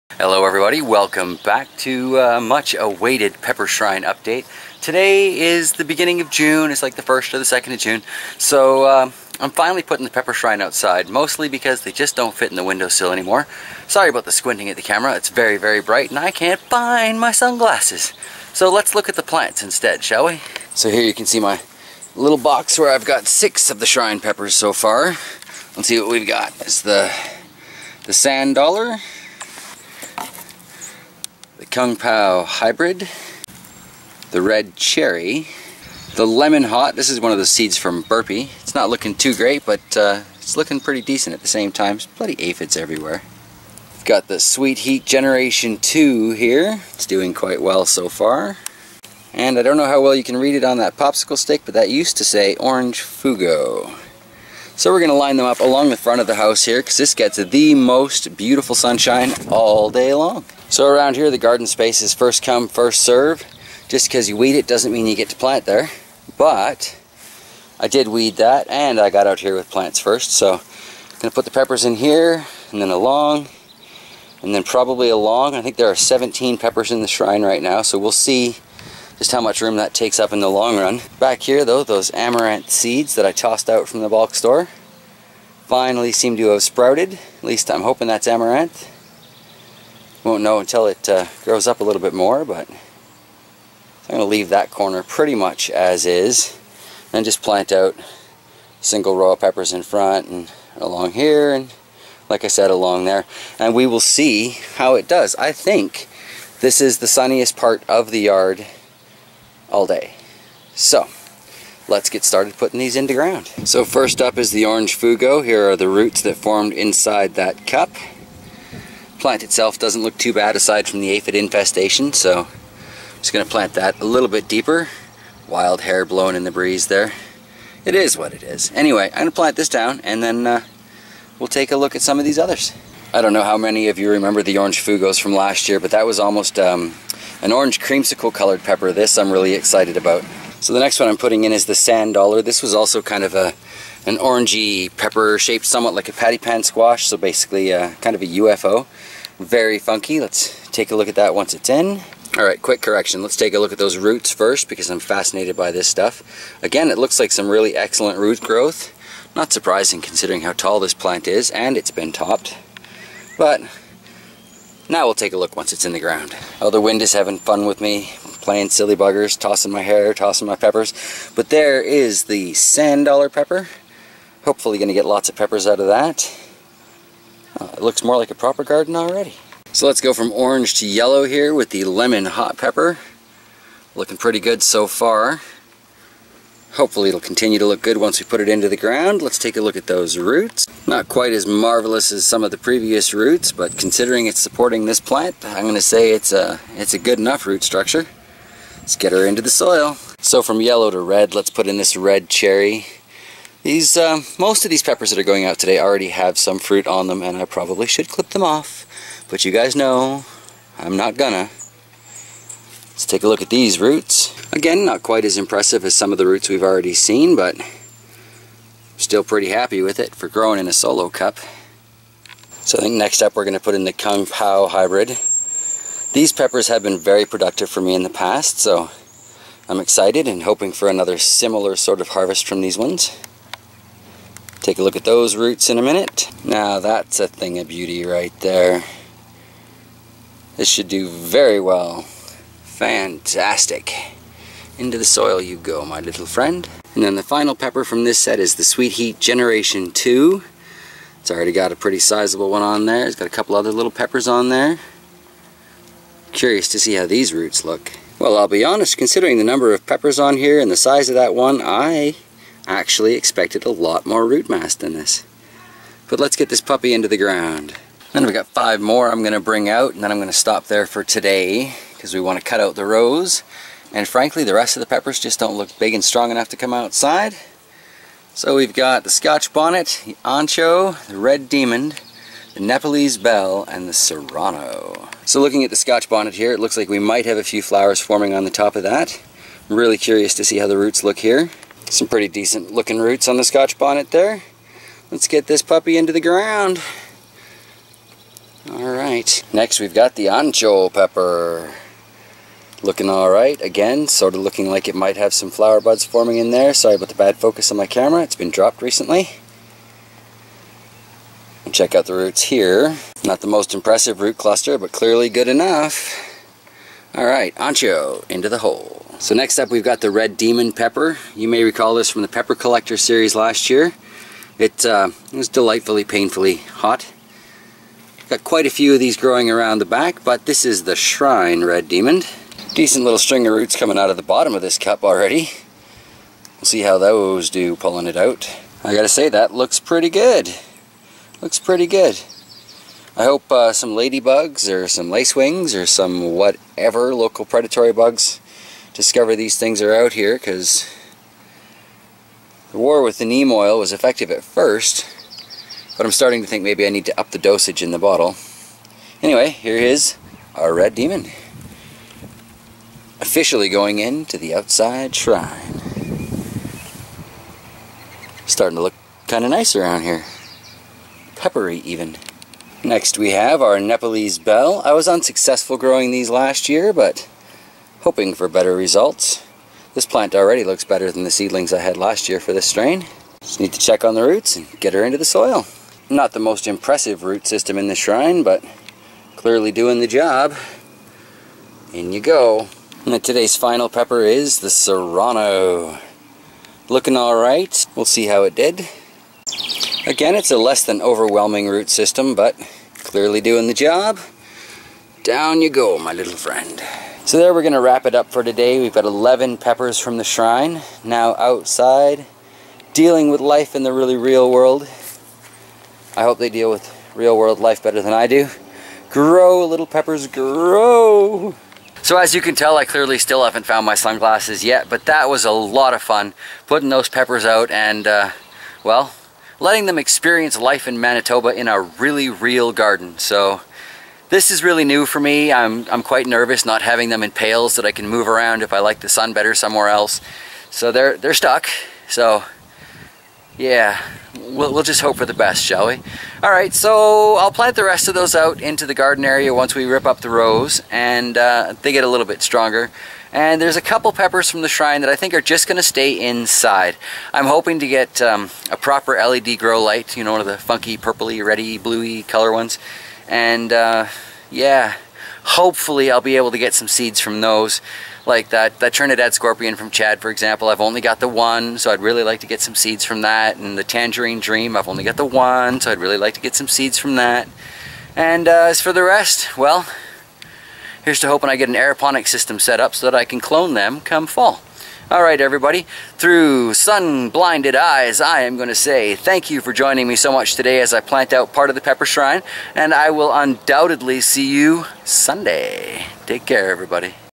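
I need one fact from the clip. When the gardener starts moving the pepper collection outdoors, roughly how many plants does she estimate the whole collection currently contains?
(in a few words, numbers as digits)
17.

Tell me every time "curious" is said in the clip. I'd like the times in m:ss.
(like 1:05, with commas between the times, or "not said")
4:16, 4:49.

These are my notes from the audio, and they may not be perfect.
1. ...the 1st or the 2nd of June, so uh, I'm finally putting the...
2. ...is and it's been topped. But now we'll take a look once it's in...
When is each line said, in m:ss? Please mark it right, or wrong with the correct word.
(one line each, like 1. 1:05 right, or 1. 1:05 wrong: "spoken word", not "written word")
1. 0:06 right
2. 2:41 right.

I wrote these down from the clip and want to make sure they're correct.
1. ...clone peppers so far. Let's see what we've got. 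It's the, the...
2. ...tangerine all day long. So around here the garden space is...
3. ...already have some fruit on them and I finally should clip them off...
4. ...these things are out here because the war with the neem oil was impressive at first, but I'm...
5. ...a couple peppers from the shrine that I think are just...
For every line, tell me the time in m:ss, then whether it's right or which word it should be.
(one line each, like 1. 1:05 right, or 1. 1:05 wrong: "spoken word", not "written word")
1. 0:23 wrong: "shrine", not "clone"
2. 0:58 wrong: "sunshine", not "tangerine"
3. 3:25 wrong: "probably", not "finally"
4. 5:49 wrong: "effective", not "impressive"
5. 7:33 right.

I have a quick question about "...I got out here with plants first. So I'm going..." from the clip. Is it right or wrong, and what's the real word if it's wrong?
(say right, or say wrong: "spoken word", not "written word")
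right.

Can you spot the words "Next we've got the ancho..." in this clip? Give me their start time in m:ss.
4:59.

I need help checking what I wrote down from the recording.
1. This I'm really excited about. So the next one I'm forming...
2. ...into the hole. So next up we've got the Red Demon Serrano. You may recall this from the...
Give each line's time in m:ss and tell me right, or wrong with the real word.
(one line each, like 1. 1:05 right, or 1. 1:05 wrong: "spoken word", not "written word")
1. 2:18 wrong: "putting", not "forming"
2. 5:18 wrong: "Pepper", not "Serrano".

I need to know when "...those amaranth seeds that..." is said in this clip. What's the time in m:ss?
1:21.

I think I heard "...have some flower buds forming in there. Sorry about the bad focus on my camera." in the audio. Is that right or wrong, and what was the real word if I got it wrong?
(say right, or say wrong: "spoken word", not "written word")
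right.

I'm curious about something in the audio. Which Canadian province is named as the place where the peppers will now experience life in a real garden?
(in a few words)
Manitoba.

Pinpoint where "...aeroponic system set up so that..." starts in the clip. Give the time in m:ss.
8:01.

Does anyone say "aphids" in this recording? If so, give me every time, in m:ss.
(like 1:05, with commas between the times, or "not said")
0:42, 2:01.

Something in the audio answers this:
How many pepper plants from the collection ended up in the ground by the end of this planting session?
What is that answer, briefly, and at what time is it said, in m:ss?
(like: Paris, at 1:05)
11, at 6:49.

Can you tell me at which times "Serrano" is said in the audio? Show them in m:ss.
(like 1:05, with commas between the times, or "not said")
4:43, 6:34.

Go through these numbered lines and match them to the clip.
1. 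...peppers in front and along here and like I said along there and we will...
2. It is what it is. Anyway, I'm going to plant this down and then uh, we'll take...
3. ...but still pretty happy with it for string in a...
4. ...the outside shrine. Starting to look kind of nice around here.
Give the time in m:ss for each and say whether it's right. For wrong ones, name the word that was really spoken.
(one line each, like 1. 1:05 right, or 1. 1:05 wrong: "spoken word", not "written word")
1. 1:39 right
2. 2:07 right
3. 3:37 wrong: "growing", not "string"
4. 6:04 right.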